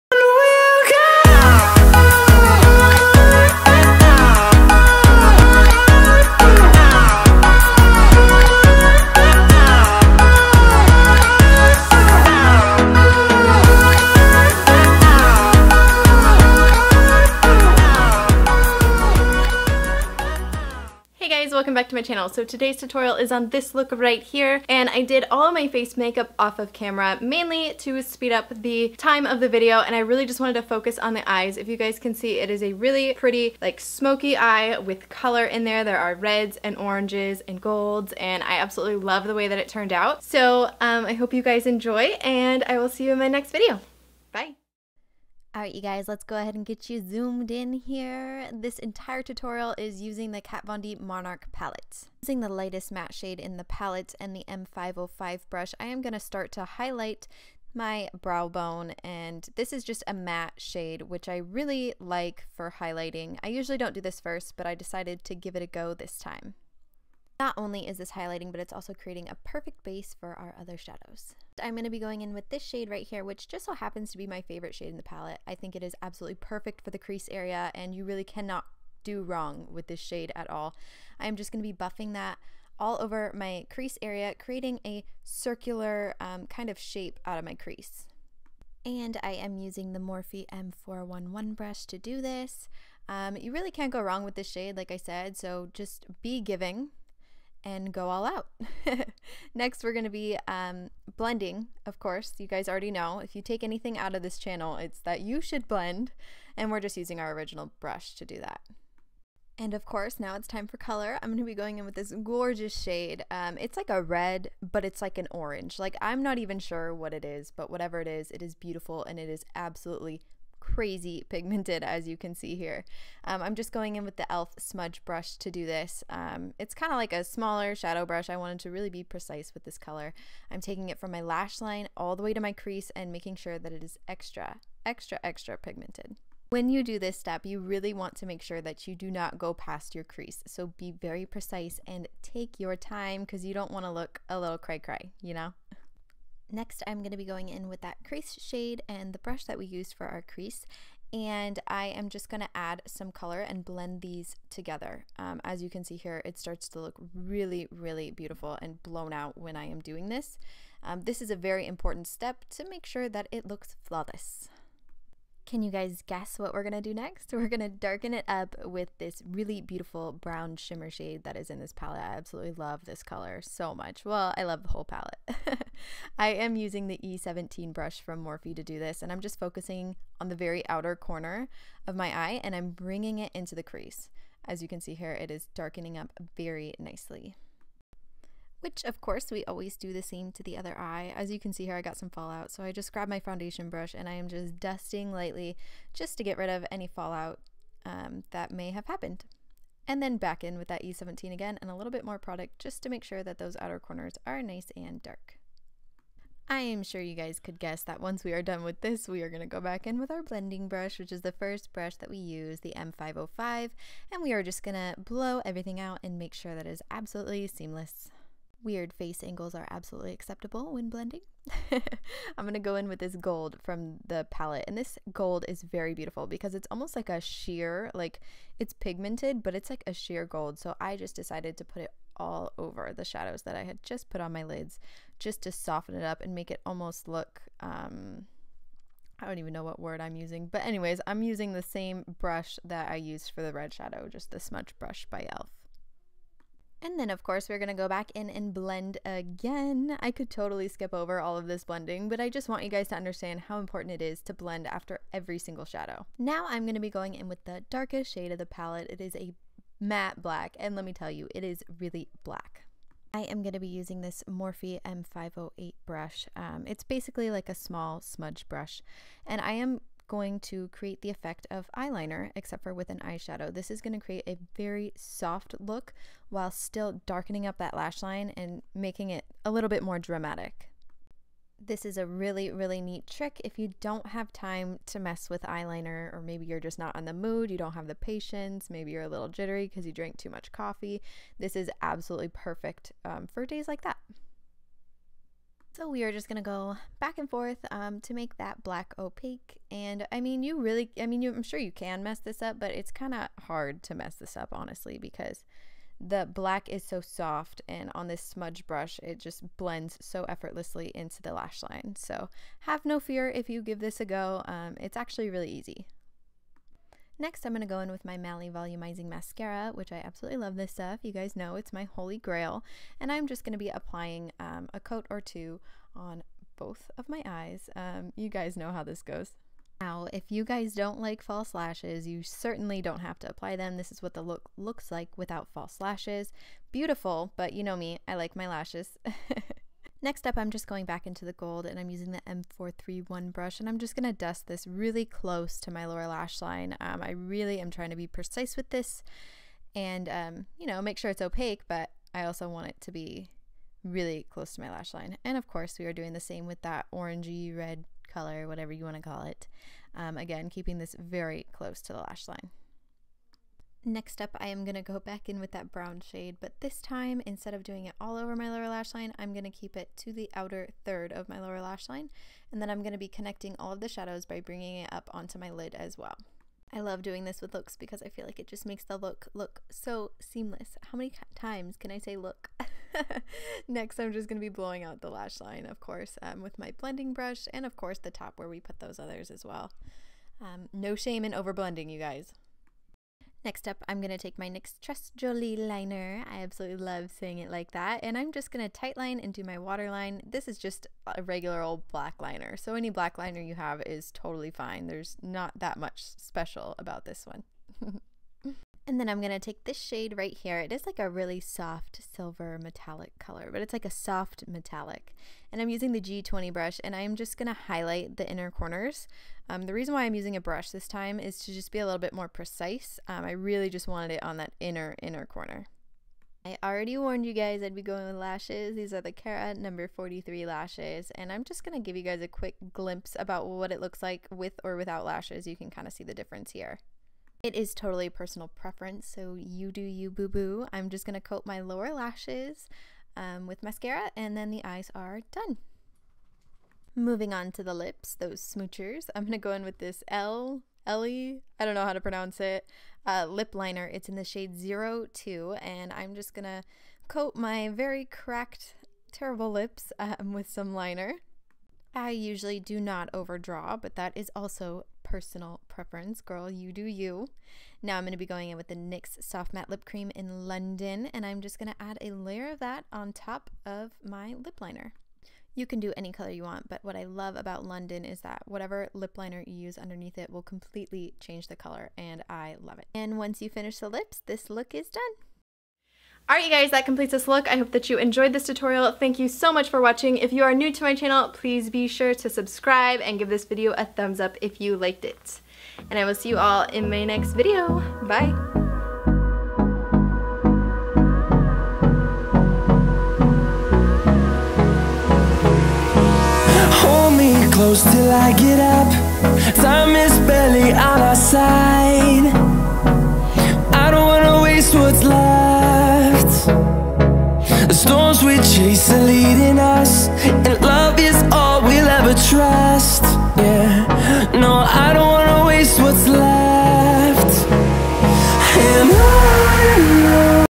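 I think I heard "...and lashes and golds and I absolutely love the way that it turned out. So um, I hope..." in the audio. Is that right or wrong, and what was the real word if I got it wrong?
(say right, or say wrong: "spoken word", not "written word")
wrong: "oranges", not "lashes".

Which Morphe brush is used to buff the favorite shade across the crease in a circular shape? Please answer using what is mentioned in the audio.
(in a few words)
M411.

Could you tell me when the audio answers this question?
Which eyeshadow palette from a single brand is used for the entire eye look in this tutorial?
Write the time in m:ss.
0:50.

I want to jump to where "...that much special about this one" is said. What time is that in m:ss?
6:45.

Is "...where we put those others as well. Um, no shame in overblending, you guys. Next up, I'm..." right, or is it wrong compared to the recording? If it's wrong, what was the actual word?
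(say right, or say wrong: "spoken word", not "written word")
right.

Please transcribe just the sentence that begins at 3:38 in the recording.
Weird face angles are absolutely acceptable when blending.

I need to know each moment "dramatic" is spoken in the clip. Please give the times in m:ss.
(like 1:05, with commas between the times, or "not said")
4:39.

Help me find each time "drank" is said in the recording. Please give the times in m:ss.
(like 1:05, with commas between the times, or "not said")
4:49.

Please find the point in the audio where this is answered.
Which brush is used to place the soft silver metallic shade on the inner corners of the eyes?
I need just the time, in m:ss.
6:56.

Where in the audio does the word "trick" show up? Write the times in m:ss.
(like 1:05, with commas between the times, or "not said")
4:43.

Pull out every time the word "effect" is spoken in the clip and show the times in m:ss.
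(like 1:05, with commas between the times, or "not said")
4:31.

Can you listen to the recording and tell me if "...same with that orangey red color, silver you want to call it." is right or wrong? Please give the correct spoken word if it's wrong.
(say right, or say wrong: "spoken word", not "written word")
wrong: "whatever", not "silver".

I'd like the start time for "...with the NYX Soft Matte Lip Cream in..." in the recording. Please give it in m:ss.
7:48.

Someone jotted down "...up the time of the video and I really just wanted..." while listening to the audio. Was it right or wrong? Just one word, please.
right.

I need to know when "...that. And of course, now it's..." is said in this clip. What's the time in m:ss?
1:48.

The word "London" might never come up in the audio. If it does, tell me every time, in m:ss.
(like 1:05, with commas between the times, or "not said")
7:50, 7:57.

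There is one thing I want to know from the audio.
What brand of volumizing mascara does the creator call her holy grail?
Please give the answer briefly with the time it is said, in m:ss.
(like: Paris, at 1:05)
Mally, at 5:18.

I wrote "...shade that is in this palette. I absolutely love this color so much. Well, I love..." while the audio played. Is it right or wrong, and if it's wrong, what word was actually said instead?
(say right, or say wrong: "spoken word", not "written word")
right.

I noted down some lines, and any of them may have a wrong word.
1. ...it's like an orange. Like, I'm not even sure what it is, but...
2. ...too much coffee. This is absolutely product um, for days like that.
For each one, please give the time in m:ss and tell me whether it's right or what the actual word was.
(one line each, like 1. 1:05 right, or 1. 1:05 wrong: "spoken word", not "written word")
1. 1:54 right
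2. 4:50 wrong: "perfect", not "product".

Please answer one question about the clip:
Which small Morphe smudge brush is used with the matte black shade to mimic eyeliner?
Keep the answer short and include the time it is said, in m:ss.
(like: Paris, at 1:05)
M508, at 4:24.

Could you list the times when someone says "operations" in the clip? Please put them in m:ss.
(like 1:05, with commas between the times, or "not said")
not said.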